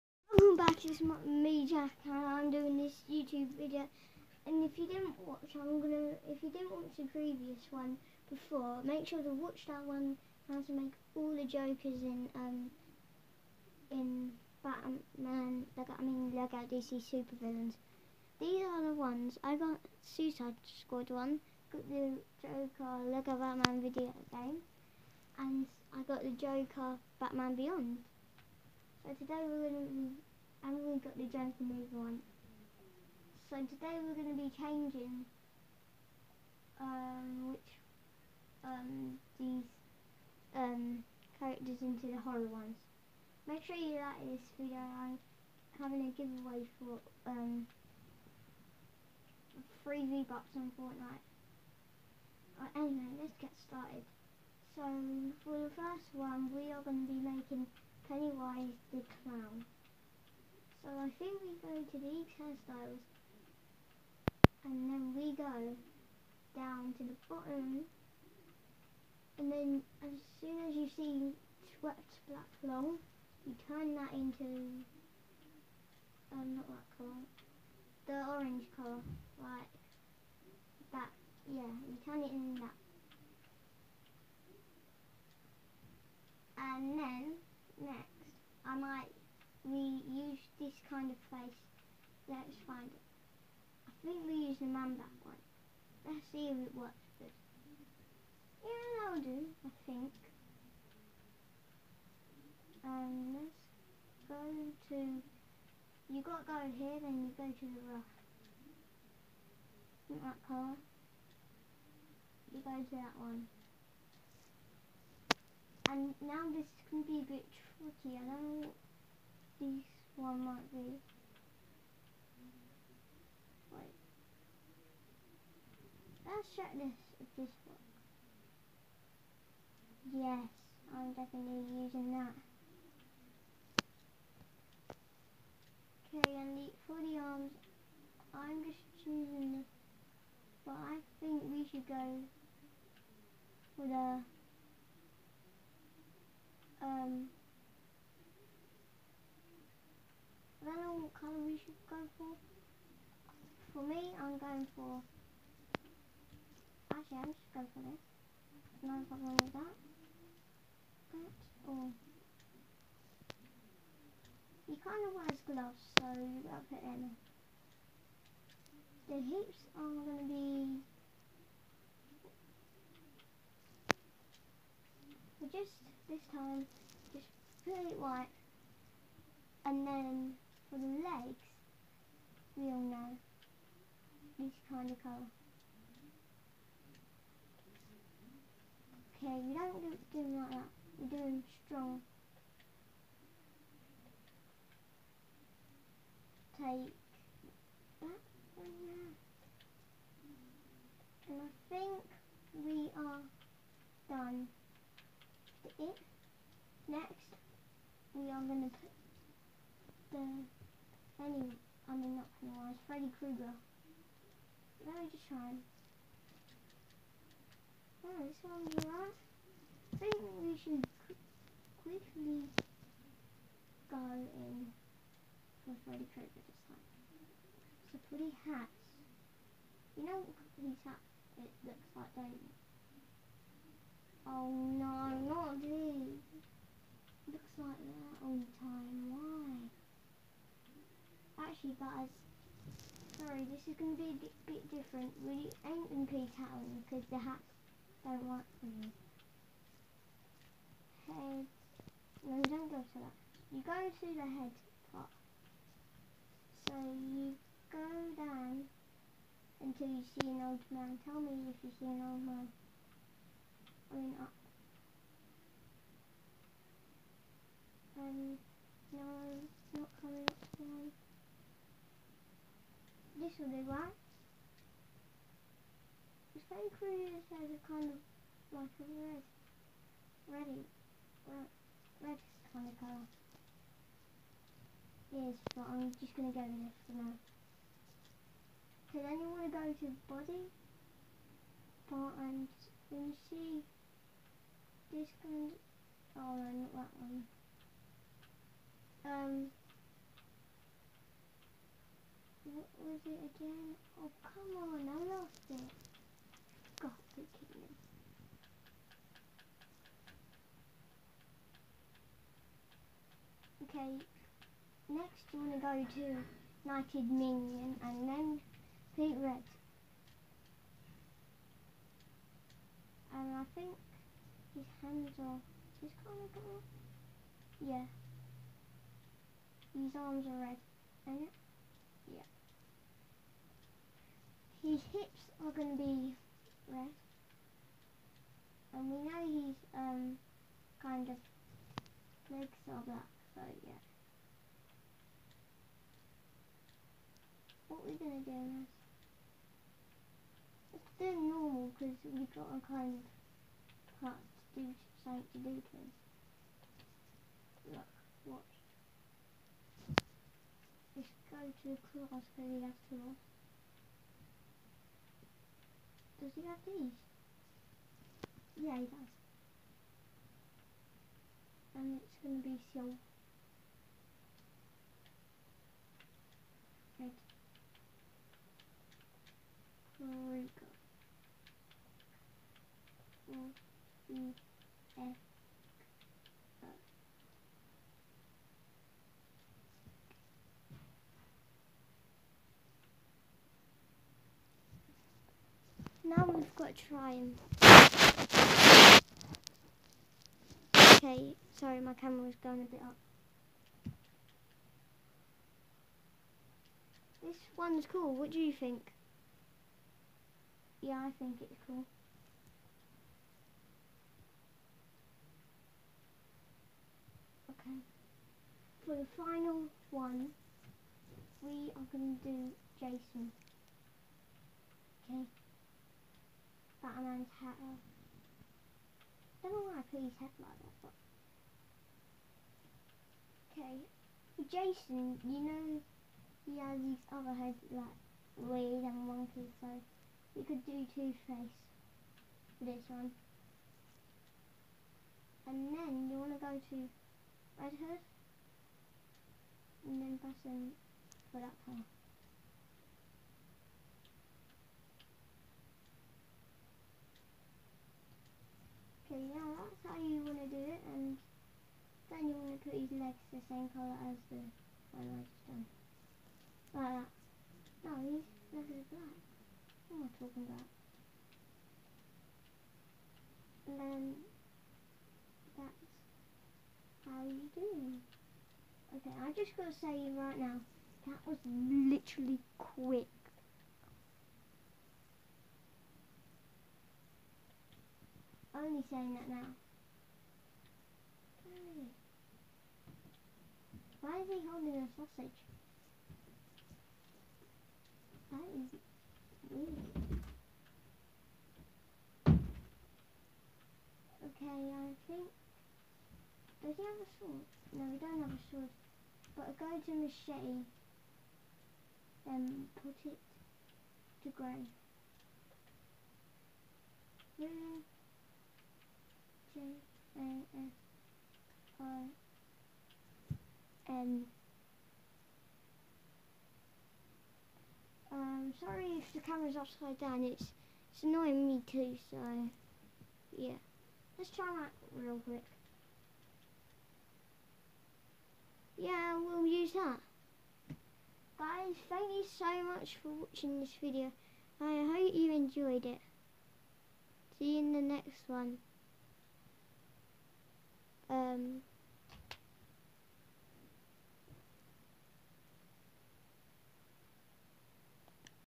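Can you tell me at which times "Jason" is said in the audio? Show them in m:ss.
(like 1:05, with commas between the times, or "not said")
7:02, 7:14.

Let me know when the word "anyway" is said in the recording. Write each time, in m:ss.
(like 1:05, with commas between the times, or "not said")
0:52.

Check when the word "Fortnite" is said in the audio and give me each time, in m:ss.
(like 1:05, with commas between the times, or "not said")
0:50.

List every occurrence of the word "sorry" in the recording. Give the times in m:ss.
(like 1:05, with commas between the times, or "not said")
4:03, 6:41, 8:48.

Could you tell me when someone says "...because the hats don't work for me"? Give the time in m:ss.
4:06.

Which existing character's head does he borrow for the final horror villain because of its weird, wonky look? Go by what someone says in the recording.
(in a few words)
Two-Face.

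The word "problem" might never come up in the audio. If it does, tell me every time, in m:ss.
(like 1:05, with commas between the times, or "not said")
2:39.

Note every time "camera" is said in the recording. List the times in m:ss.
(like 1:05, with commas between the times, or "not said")
6:41, 8:49.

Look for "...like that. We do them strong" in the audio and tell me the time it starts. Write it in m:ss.
3:10.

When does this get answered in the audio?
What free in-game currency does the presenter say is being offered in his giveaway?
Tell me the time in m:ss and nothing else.
0:50.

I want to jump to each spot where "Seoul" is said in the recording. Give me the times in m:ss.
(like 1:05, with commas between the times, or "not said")
6:12.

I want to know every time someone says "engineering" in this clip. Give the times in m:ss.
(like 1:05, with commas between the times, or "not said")
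not said.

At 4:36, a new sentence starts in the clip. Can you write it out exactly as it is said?
It's very curious as a kind of like a red, ready, red, red kind of colour.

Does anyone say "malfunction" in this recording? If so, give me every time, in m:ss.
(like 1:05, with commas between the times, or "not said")
not said.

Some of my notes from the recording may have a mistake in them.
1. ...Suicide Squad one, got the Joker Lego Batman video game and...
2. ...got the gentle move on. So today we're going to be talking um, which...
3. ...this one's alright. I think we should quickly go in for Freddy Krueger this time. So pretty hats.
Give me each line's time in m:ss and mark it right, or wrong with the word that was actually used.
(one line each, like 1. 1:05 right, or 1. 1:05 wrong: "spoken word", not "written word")
1. 0:20 right
2. 0:30 wrong: "changing", not "talking"
3. 3:38 right.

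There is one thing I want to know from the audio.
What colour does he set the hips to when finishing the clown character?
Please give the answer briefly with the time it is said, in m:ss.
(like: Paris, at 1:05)
White, at 2:57.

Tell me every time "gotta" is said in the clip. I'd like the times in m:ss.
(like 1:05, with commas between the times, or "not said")
2:46, 7:59.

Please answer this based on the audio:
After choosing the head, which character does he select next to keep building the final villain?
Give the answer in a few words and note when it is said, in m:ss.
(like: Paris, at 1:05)
Red Hood, at 7:27.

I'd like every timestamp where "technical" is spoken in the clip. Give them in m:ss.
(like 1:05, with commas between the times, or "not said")
not said.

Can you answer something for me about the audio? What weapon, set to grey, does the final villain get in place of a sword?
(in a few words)
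Machete.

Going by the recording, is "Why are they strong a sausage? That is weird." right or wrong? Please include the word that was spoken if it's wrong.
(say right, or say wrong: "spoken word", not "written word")
wrong: "holding", not "strong".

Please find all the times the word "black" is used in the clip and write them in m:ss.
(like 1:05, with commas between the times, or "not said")
1:12, 5:42, 7:48.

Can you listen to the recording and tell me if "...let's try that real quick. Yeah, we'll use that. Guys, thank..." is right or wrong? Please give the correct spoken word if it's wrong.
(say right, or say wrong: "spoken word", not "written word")
right.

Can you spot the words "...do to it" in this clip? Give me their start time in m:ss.
5:55.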